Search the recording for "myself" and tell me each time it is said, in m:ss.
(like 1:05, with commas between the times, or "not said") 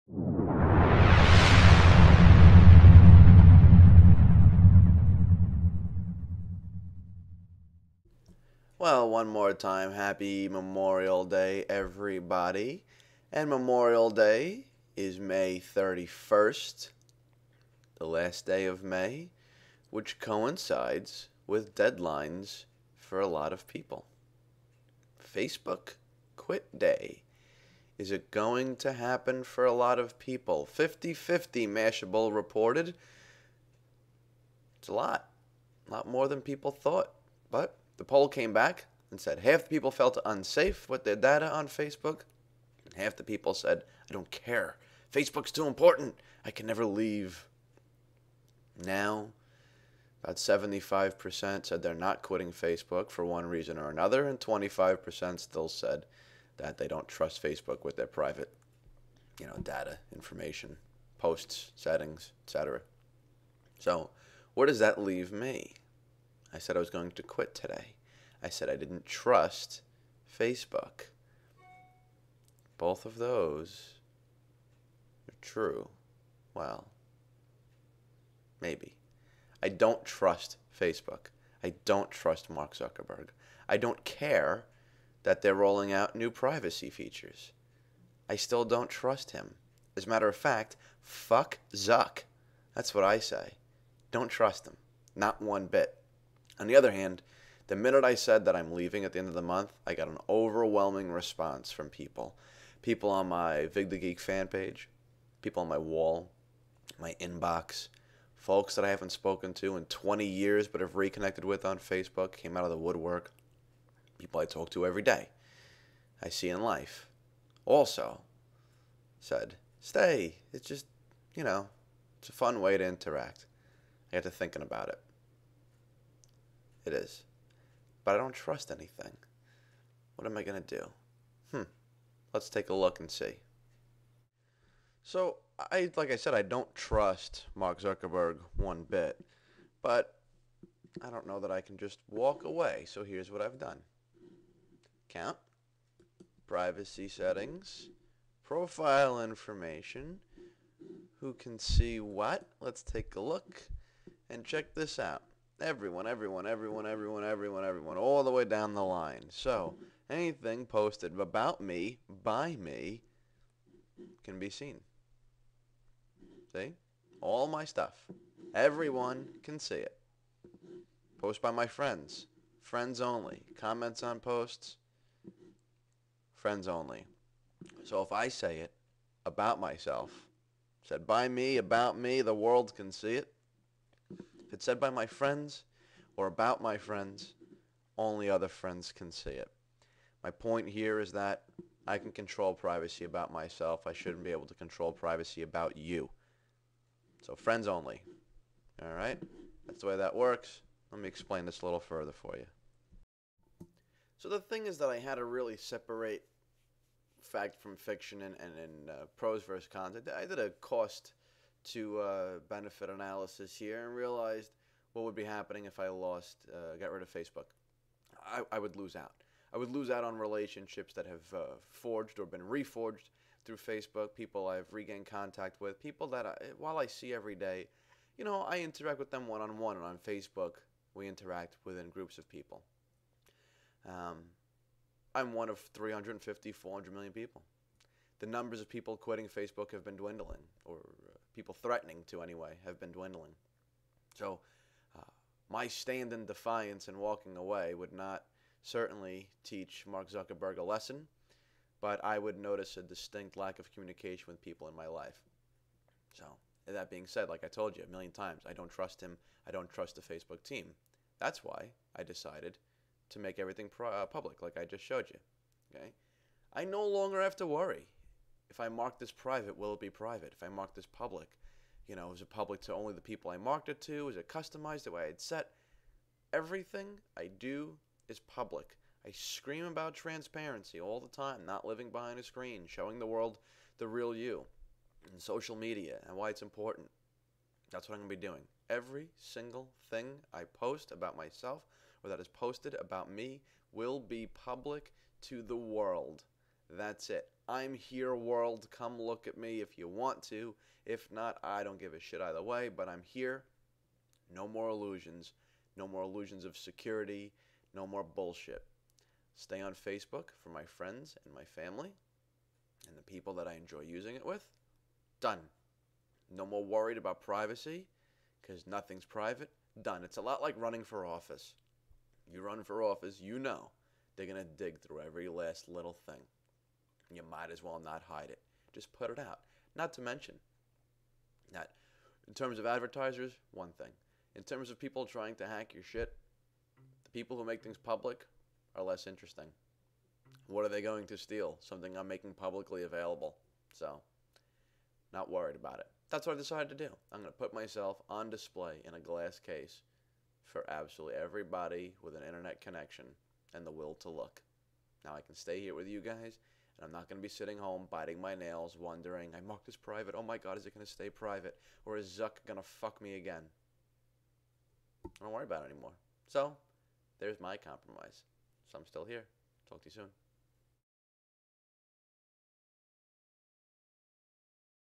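2:59, 3:13, 4:51, 5:47.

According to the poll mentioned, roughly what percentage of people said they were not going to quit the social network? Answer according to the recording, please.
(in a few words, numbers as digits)
75%.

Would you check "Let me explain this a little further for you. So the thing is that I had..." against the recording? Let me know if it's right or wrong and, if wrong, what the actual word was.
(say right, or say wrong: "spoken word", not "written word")
right.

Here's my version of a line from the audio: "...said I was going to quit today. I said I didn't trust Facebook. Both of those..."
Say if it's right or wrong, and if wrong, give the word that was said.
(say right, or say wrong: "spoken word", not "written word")
right.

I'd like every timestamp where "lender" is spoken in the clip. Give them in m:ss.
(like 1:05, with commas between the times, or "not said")
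not said.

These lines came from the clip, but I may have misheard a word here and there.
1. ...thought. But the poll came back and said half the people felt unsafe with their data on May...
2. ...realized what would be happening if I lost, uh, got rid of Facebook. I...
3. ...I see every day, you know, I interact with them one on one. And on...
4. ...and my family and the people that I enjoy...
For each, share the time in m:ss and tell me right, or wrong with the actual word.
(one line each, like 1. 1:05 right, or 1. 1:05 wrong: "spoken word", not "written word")
1. 0:36 wrong: "Facebook", not "May"
2. 3:33 right
3. 3:46 right
4. 5:11 right.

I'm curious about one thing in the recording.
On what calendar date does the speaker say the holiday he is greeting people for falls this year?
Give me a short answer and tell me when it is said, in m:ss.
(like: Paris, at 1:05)
May 31st, at 0:15.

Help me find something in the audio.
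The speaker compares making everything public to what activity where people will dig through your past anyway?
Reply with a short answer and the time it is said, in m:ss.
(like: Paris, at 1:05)
Running for office, at 5:20.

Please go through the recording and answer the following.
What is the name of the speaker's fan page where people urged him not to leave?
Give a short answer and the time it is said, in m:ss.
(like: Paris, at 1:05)
Vig the Geek, at 1:43.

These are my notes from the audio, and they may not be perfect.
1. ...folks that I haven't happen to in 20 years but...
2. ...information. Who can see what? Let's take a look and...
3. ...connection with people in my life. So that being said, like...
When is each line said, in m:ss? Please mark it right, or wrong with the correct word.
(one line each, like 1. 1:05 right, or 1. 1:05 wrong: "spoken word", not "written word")
1. 1:48 wrong: "spoken", not "happen"
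2. 2:29 right
3. 4:13 wrong: "communication", not "connection".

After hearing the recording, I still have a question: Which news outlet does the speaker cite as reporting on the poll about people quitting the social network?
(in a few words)
Mashable.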